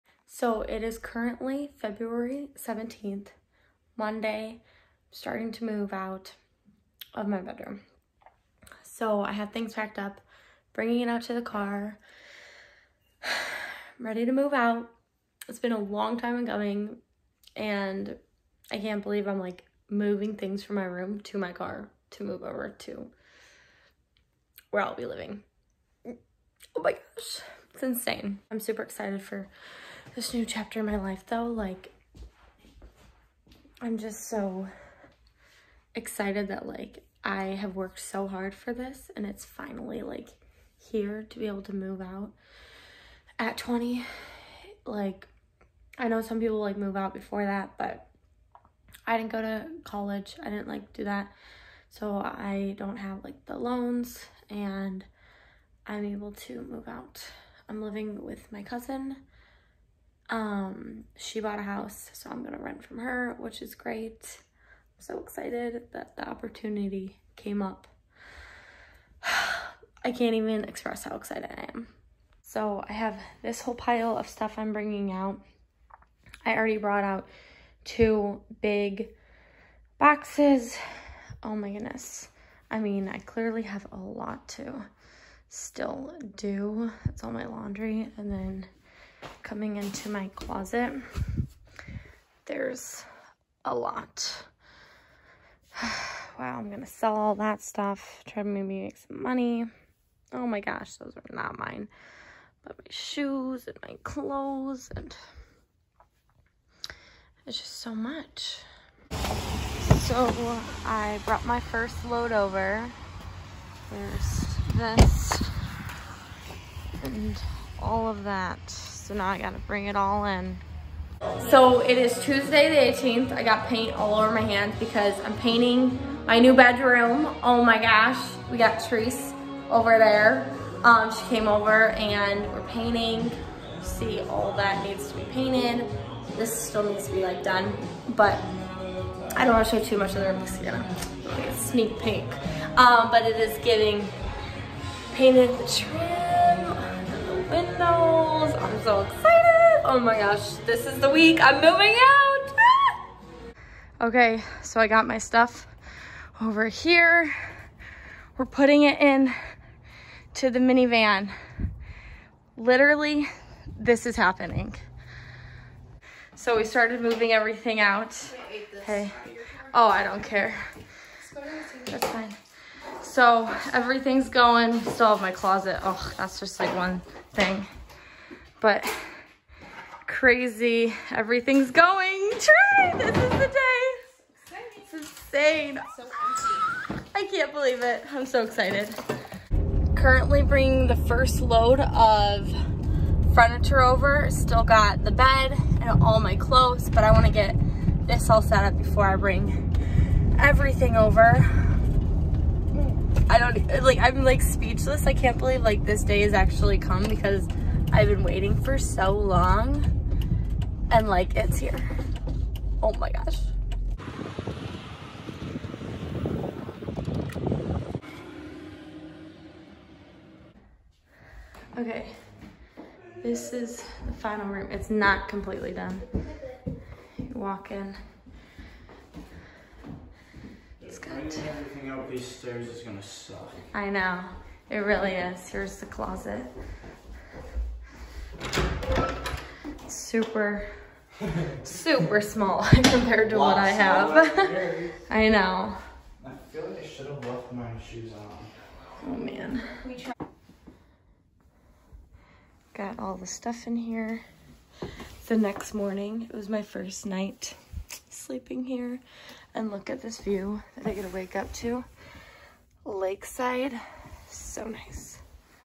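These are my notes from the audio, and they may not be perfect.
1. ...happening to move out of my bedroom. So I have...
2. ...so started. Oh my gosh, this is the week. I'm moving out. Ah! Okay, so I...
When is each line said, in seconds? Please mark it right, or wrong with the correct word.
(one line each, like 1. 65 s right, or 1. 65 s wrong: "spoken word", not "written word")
1. 5 s wrong: "starting", not "happening"
2. 148 s wrong: "excited", not "started".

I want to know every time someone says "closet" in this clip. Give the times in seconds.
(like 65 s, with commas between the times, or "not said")
90 s, 175 s, 235 s.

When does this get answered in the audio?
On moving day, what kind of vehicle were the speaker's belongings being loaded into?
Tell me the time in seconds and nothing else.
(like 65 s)
160 s.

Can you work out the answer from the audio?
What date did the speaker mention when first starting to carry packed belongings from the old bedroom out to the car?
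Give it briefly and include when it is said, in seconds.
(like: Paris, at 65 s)
February 17th, at 1 s.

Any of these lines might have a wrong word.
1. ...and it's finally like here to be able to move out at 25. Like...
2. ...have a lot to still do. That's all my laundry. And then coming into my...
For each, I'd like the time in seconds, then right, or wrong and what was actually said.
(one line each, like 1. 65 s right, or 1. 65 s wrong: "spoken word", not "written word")
1. 39 s wrong: "20", not "25"
2. 83 s right.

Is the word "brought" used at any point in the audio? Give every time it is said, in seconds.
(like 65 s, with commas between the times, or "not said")
76 s, 111 s.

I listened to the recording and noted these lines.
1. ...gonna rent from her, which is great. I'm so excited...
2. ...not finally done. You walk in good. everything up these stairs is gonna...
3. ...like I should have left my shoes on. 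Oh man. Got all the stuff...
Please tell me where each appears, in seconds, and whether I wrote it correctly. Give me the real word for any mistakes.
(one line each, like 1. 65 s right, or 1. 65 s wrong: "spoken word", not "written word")
1. 62 s right
2. 224 s wrong: "completely", not "finally"
3. 246 s right.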